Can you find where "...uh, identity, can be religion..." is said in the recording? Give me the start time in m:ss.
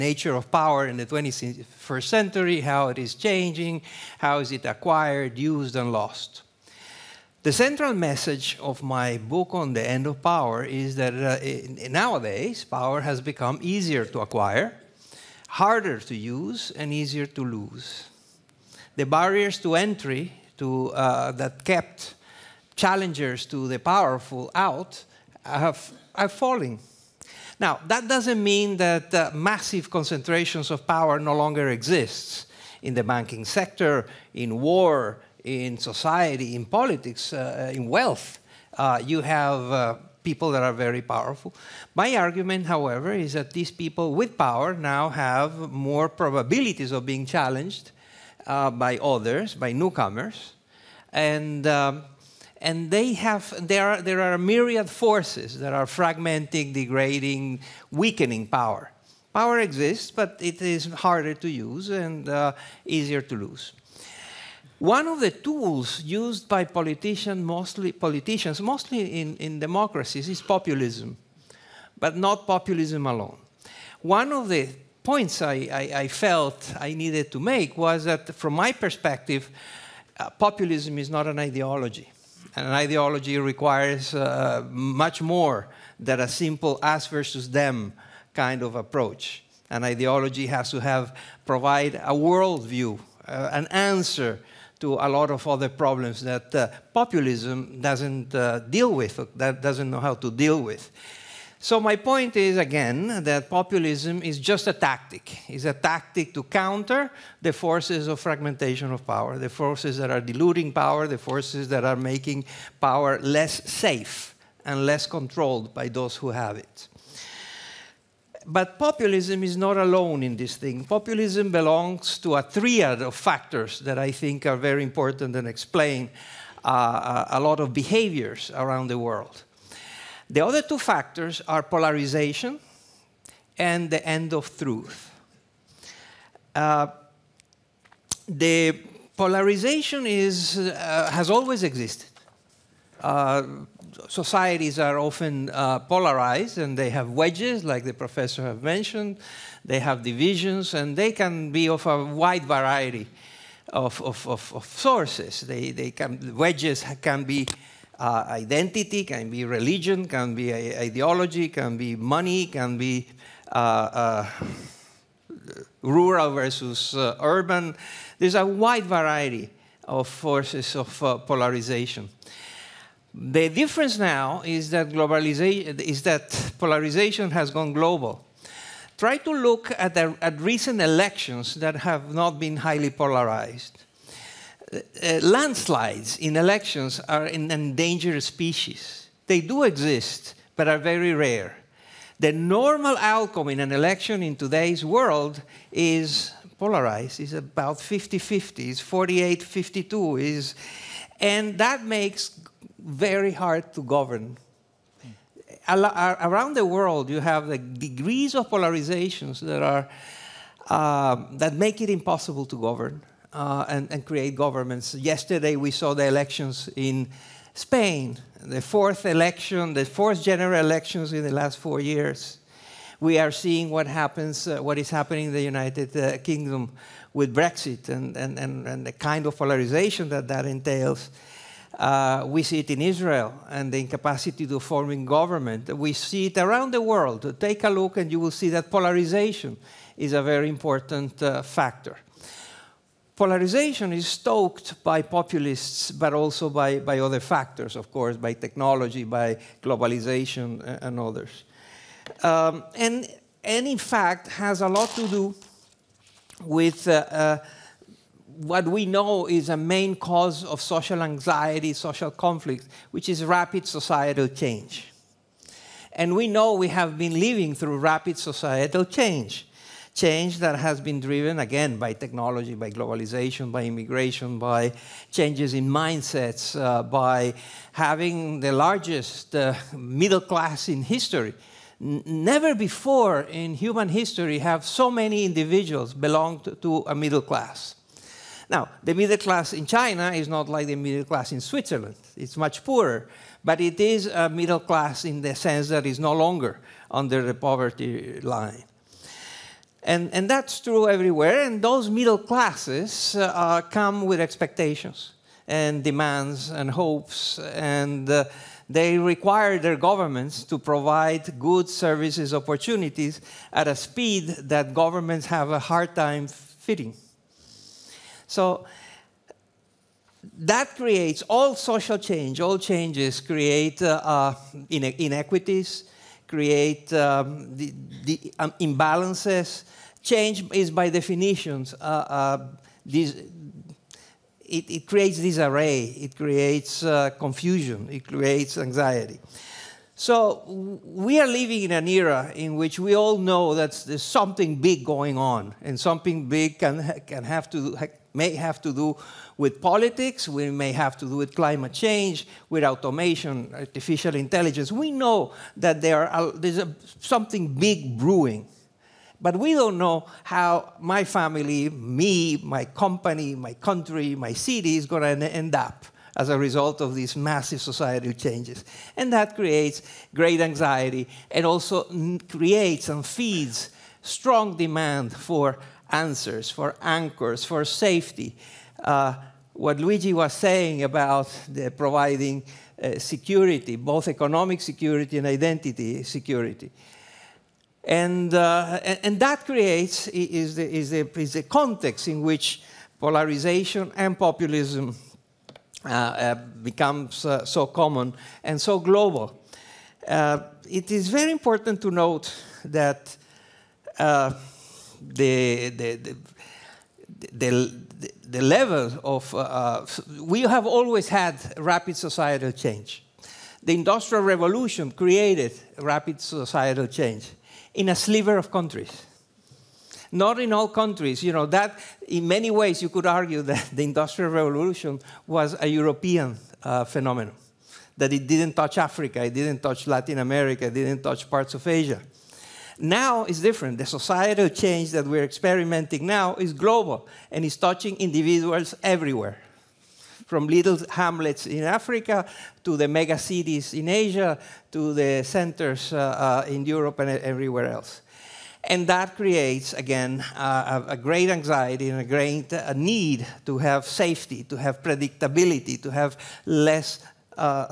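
2:37.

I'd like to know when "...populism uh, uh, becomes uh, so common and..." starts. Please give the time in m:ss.
6:34.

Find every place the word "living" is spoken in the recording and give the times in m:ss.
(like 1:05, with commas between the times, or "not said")
4:27, 5:41.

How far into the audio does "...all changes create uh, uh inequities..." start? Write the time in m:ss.
5:22.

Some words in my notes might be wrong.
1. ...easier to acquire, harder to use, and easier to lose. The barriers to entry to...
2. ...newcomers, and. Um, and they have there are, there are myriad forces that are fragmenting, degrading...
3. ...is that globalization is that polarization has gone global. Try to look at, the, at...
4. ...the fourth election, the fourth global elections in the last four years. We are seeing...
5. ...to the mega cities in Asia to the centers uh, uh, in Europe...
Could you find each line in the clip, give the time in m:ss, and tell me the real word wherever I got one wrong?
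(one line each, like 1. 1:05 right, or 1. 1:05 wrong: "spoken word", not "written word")
1. 0:13 right
2. 0:49 right
3. 2:54 right
4. 3:38 wrong: "general", not "global"
5. 7:22 right.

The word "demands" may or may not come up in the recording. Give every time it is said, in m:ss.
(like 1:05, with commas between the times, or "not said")
5:05, 6:14.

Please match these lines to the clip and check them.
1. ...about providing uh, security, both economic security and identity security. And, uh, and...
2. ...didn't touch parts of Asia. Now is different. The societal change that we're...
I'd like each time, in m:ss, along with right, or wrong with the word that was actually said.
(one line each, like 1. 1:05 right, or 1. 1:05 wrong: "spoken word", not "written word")
1. 6:20 right
2. 7:10 right.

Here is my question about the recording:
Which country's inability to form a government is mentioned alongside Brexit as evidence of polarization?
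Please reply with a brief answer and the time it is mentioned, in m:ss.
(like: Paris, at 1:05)
Israel, at 3:52.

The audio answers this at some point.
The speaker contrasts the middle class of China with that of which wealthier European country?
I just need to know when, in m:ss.
4:51.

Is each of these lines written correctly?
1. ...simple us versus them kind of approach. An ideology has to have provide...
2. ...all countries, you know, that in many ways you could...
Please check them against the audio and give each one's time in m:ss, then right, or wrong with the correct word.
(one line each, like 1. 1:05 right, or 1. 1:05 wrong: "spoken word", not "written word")
1. 1:26 right
2. 7:00 right.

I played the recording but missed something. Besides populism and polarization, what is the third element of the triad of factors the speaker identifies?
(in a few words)
The end of truth.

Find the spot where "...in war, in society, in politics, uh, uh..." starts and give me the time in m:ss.
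0:34.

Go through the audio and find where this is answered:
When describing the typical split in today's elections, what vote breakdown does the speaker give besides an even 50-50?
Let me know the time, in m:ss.
3:18.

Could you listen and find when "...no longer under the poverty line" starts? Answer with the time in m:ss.
4:55.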